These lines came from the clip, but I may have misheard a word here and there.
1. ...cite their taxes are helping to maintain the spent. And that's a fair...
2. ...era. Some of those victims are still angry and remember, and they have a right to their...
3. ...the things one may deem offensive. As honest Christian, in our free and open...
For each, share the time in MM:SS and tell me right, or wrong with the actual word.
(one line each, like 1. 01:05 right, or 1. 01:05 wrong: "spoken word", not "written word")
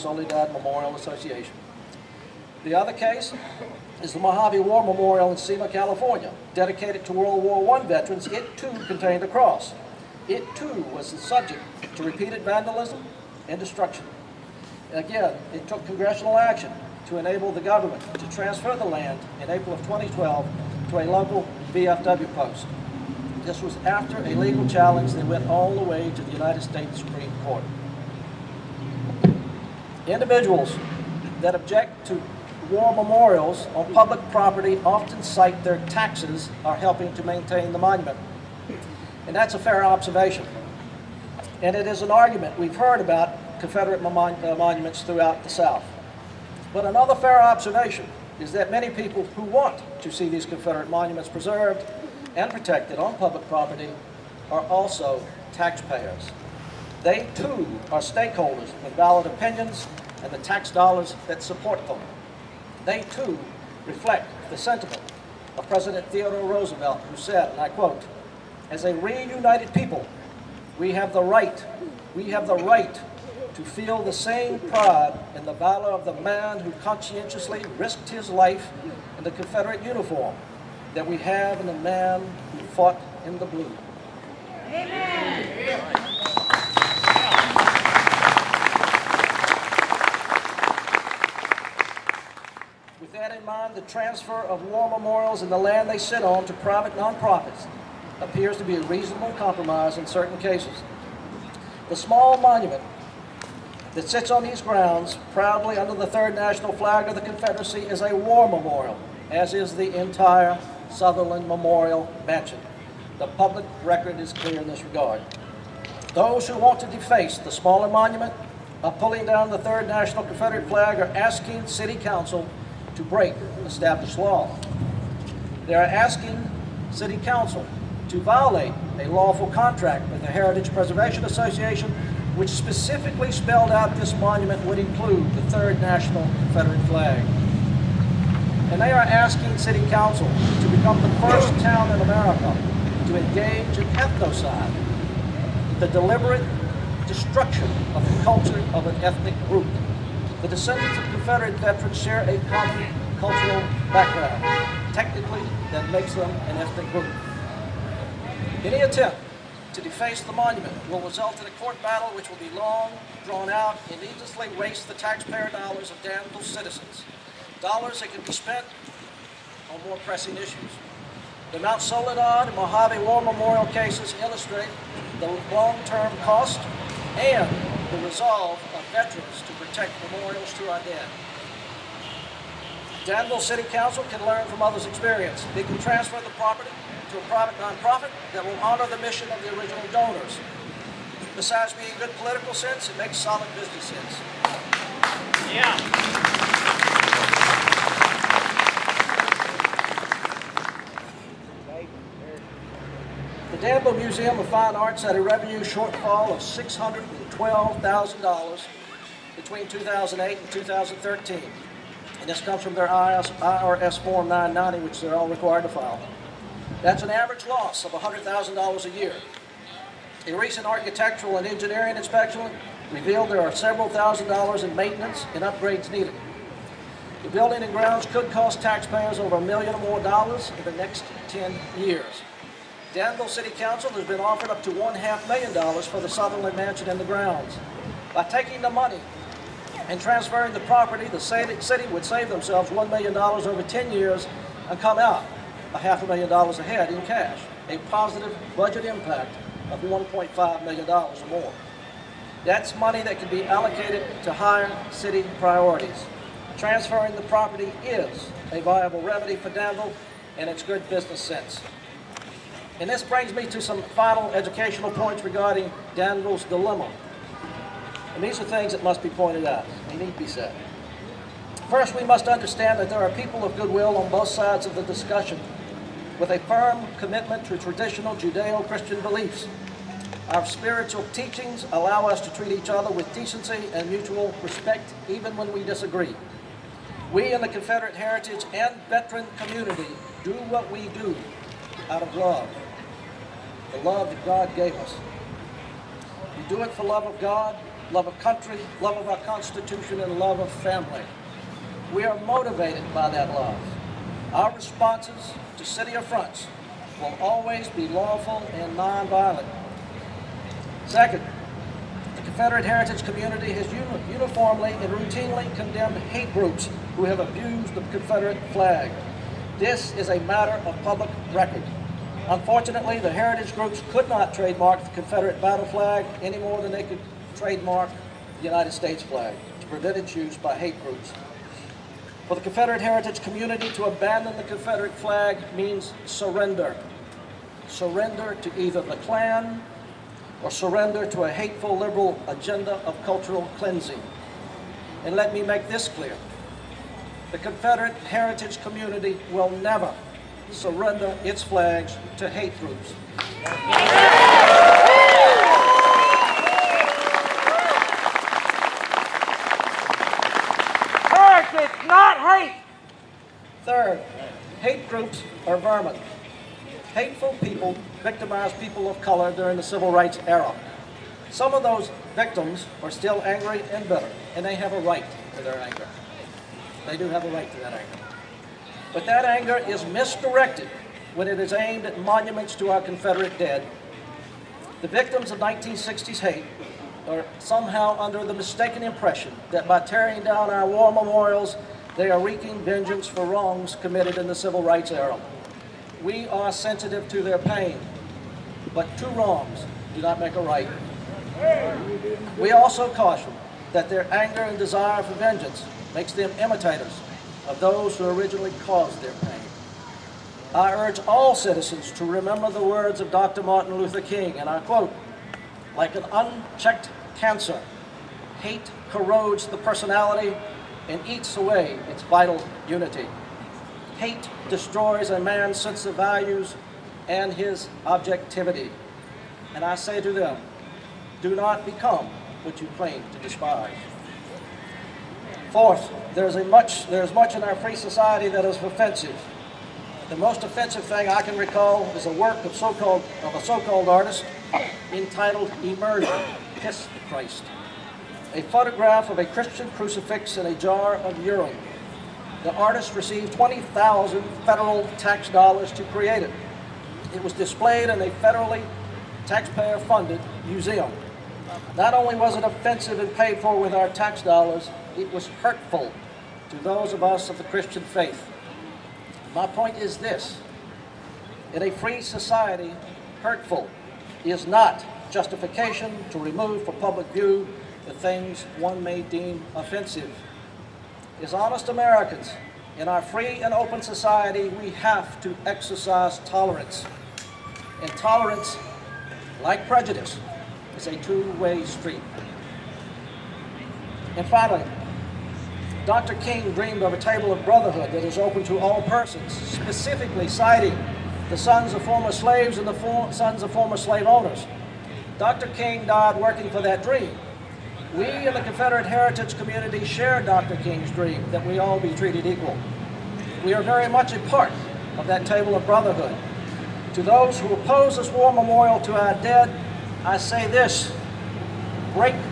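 1. 00:35 wrong: "monument", not "spent"
2. 06:10 wrong: "bitter", not "remember"
3. 07:57 wrong: "Americans", not "Christian".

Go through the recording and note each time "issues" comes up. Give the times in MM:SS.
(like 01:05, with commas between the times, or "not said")
02:50.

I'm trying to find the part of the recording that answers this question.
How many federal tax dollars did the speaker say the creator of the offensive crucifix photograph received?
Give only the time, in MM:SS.
07:33.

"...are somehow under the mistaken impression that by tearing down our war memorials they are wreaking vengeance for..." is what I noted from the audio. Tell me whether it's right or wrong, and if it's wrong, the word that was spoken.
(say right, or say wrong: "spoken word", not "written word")
right.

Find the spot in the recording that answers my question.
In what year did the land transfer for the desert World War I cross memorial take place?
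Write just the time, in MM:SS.
00:19.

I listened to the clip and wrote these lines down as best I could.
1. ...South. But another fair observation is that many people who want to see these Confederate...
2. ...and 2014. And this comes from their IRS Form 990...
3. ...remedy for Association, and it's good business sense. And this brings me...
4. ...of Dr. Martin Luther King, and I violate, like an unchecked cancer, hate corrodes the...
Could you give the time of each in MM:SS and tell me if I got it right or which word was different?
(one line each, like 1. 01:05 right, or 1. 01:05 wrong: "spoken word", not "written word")
1. 00:45 right
2. 03:30 wrong: "2013", not "2014"
3. 04:19 wrong: "Danville", not "Association"
4. 06:53 wrong: "quote", not "violate".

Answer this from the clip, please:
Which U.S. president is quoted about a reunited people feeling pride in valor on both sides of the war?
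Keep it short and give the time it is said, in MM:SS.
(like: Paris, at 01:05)
Theodore Roosevelt, at 01:06.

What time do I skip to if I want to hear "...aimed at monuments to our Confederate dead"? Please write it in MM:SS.
06:21.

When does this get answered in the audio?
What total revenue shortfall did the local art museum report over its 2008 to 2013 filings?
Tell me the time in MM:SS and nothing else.
03:26.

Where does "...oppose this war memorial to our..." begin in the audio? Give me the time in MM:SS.
08:37.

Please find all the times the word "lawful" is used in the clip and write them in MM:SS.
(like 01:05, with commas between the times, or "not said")
02:09, 05:07.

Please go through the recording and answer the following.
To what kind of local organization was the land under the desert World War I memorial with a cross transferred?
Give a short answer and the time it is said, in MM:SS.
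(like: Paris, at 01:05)
VFW post, at 00:21.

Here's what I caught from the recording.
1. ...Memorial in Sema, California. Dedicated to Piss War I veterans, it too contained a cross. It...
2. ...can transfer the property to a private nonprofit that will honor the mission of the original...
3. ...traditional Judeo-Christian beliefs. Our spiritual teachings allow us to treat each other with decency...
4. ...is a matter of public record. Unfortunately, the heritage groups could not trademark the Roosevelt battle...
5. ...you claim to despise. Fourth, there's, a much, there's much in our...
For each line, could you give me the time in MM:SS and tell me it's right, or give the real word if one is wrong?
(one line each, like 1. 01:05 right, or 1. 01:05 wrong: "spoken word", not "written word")
1. 00:04 wrong: "World", not "Piss"
2. 03:05 right
3. 04:37 right
4. 05:19 wrong: "Confederate", not "Roosevelt"
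5. 07:12 right.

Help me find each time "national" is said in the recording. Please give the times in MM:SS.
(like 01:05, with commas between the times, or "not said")
01:46, 01:59, 02:15.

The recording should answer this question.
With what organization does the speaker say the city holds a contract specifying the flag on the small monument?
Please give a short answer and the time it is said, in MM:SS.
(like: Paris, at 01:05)
Heritage Preservation Association, at 02:10.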